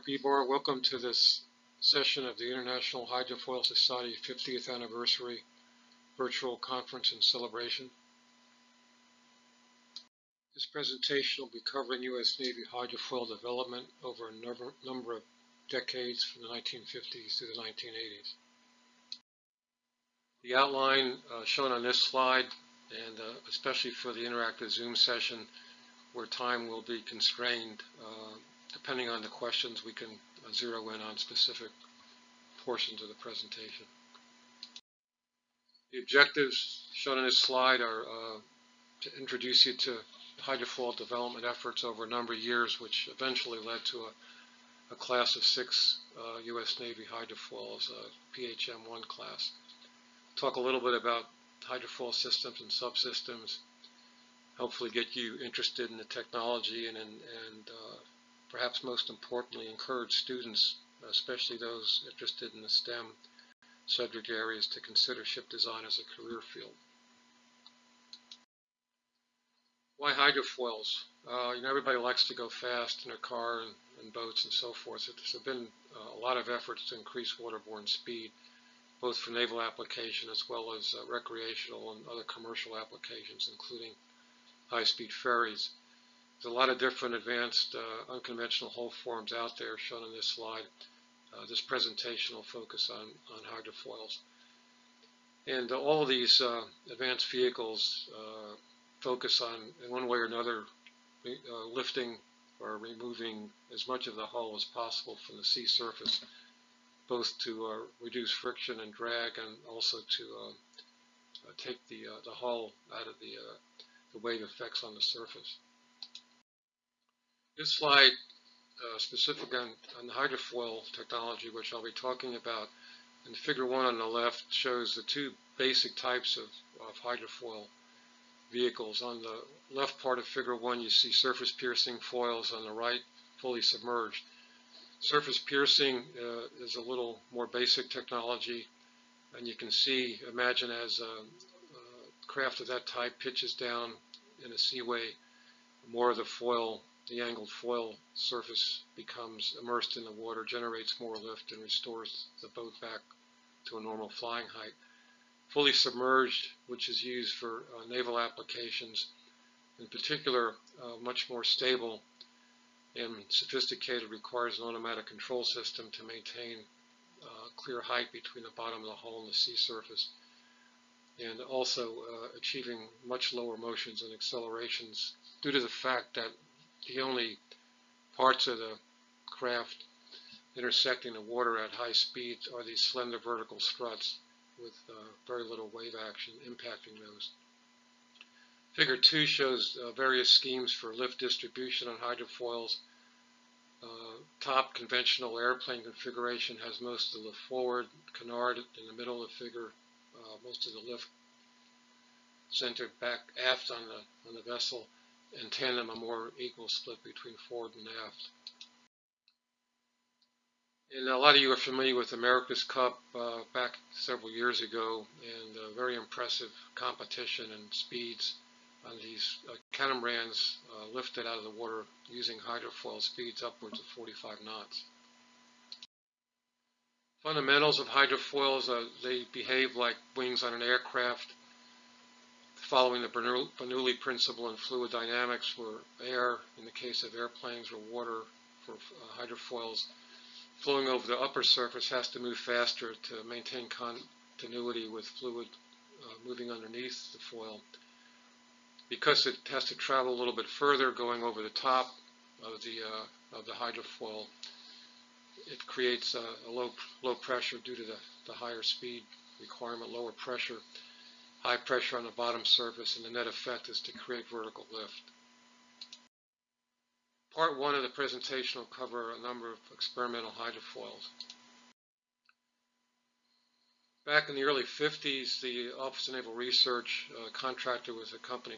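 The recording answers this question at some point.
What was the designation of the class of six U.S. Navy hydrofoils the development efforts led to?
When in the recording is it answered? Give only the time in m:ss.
0:48.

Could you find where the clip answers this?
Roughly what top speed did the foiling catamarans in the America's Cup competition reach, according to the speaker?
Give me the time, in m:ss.
3:43.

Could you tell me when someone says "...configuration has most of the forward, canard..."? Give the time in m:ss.
3:15.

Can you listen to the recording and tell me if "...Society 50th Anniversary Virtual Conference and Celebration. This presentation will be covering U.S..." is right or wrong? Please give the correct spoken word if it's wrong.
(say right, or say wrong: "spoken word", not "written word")
right.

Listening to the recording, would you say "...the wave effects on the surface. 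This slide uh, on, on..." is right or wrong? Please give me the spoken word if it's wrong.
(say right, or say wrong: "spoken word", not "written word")
right.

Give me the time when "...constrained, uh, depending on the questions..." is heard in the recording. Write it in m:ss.
0:27.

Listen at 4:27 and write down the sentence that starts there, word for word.
Part one of the presentation will cover a number of experimental hydrofoils.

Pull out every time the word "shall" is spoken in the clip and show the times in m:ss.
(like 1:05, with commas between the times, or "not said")
not said.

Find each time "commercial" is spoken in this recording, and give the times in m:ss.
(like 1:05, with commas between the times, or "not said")
1:22.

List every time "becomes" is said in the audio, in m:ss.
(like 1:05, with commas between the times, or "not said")
2:28.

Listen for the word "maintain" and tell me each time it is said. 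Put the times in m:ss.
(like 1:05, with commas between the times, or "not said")
2:46, 4:03.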